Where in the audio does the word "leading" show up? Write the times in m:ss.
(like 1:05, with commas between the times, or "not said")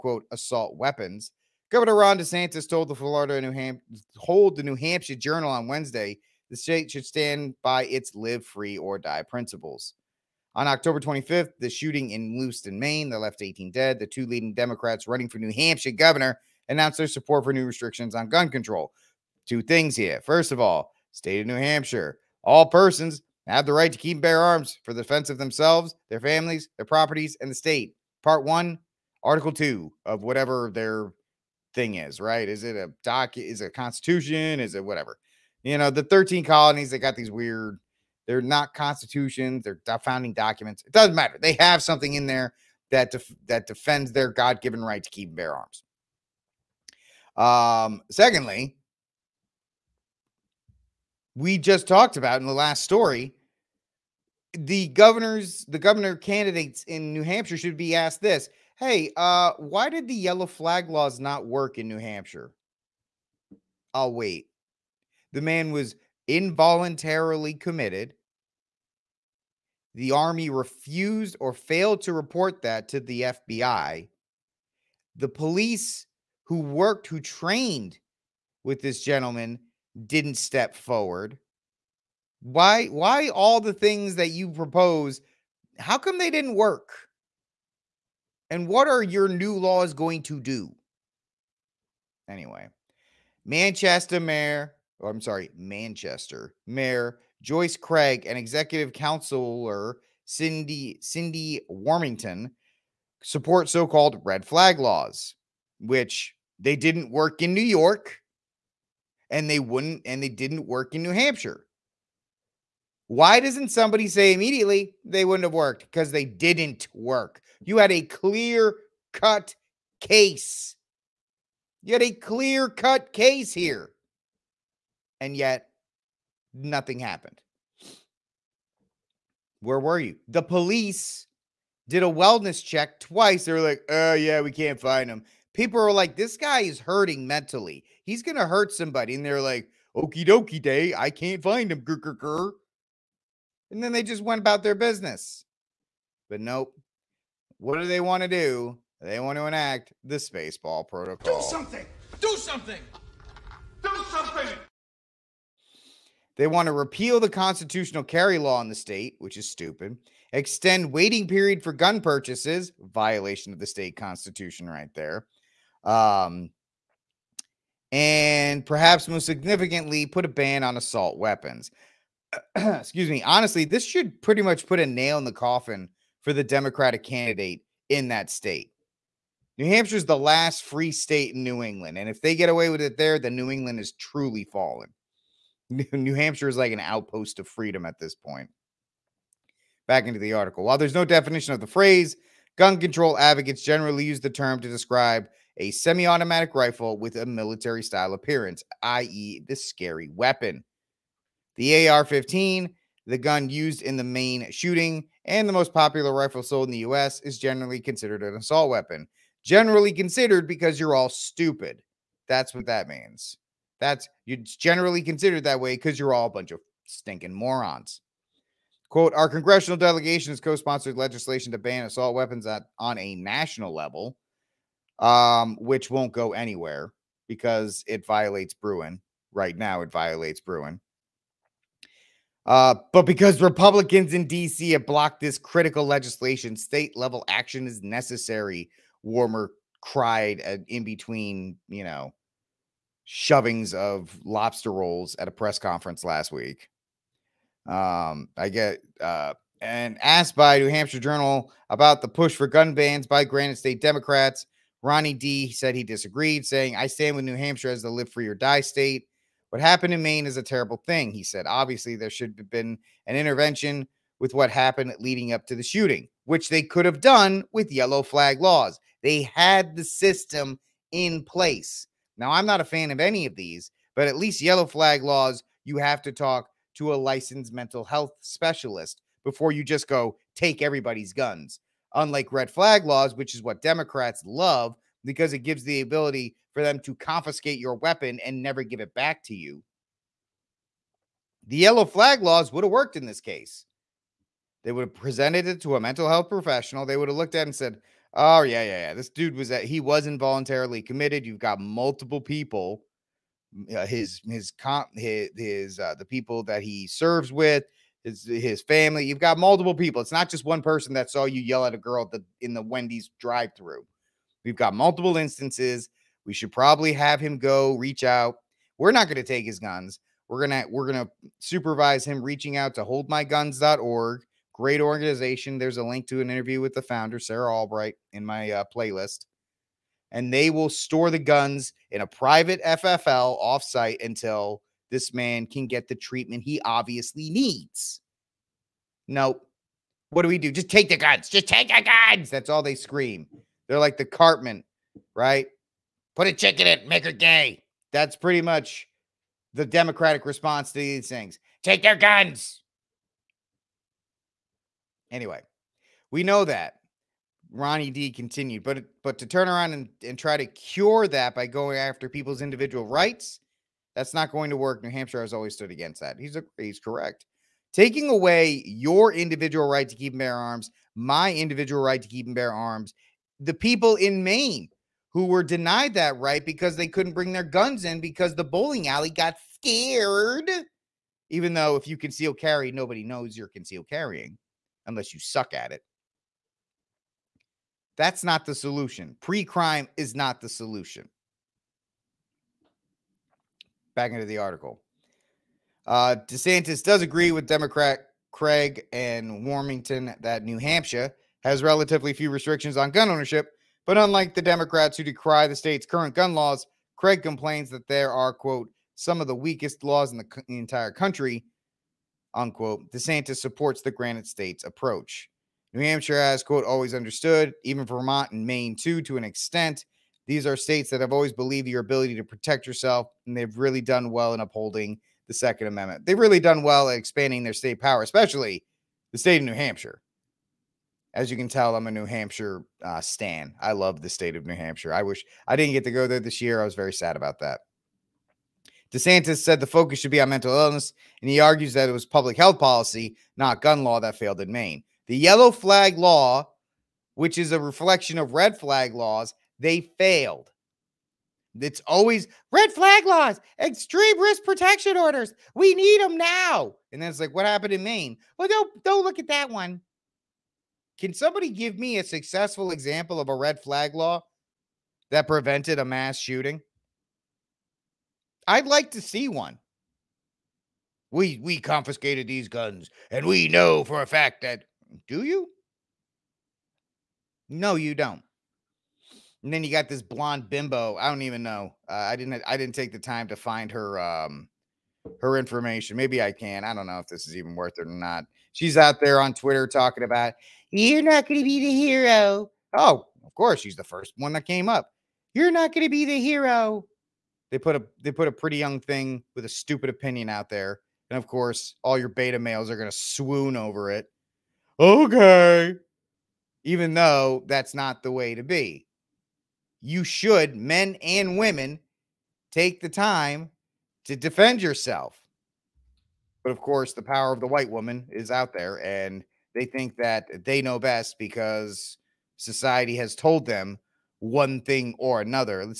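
0:14, 4:24.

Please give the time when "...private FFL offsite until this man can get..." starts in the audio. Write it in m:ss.
5:32.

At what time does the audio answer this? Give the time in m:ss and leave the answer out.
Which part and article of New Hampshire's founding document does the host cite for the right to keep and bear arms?
0:28.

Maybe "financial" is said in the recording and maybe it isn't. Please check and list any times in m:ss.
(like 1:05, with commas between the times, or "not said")
not said.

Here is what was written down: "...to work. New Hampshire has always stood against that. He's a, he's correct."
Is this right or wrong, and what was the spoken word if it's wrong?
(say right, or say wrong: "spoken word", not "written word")
right.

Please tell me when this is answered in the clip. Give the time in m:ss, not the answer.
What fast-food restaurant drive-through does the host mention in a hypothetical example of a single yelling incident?
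5:12.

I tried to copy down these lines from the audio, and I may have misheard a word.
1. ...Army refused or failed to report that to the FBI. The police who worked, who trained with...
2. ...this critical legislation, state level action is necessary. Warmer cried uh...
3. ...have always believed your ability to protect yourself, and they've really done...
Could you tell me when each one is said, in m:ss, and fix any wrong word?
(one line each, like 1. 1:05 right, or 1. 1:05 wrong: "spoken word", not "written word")
1. 1:10 right
2. 3:55 right
3. 7:00 right.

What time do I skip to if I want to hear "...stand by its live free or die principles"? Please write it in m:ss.
0:07.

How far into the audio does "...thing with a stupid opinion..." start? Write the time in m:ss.
8:18.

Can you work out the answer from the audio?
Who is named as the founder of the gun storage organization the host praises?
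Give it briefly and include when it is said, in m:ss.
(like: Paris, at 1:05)
Sarah Albrecht, at 5:27.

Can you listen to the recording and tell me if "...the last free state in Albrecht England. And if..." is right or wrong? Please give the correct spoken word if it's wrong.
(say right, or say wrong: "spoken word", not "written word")
wrong: "New", not "Albrecht".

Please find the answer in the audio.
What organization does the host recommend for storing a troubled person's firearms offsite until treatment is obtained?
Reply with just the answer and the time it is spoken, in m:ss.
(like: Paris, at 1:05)
holdmyguns.org, at 5:22.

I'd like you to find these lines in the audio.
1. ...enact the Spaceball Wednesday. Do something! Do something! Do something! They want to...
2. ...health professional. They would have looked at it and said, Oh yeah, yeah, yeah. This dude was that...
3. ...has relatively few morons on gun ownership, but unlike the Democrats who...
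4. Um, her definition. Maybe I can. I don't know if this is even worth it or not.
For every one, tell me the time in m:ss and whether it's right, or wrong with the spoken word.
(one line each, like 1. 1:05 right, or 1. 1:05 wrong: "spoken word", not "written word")
1. 2:29 wrong: "Protocol", not "Wednesday"
2. 4:56 right
3. 6:41 wrong: "restrictions", not "morons"
4. 8:03 wrong: "information", not "definition".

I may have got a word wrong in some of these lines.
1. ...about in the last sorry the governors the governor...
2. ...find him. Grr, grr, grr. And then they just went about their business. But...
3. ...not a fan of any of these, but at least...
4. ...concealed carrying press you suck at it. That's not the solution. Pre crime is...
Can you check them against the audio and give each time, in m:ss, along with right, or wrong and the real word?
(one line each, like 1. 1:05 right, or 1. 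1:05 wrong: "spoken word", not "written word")
1. 0:52 wrong: "story", not "sorry"
2. 2:21 right
3. 4:32 right
4. 6:23 wrong: "unless", not "press".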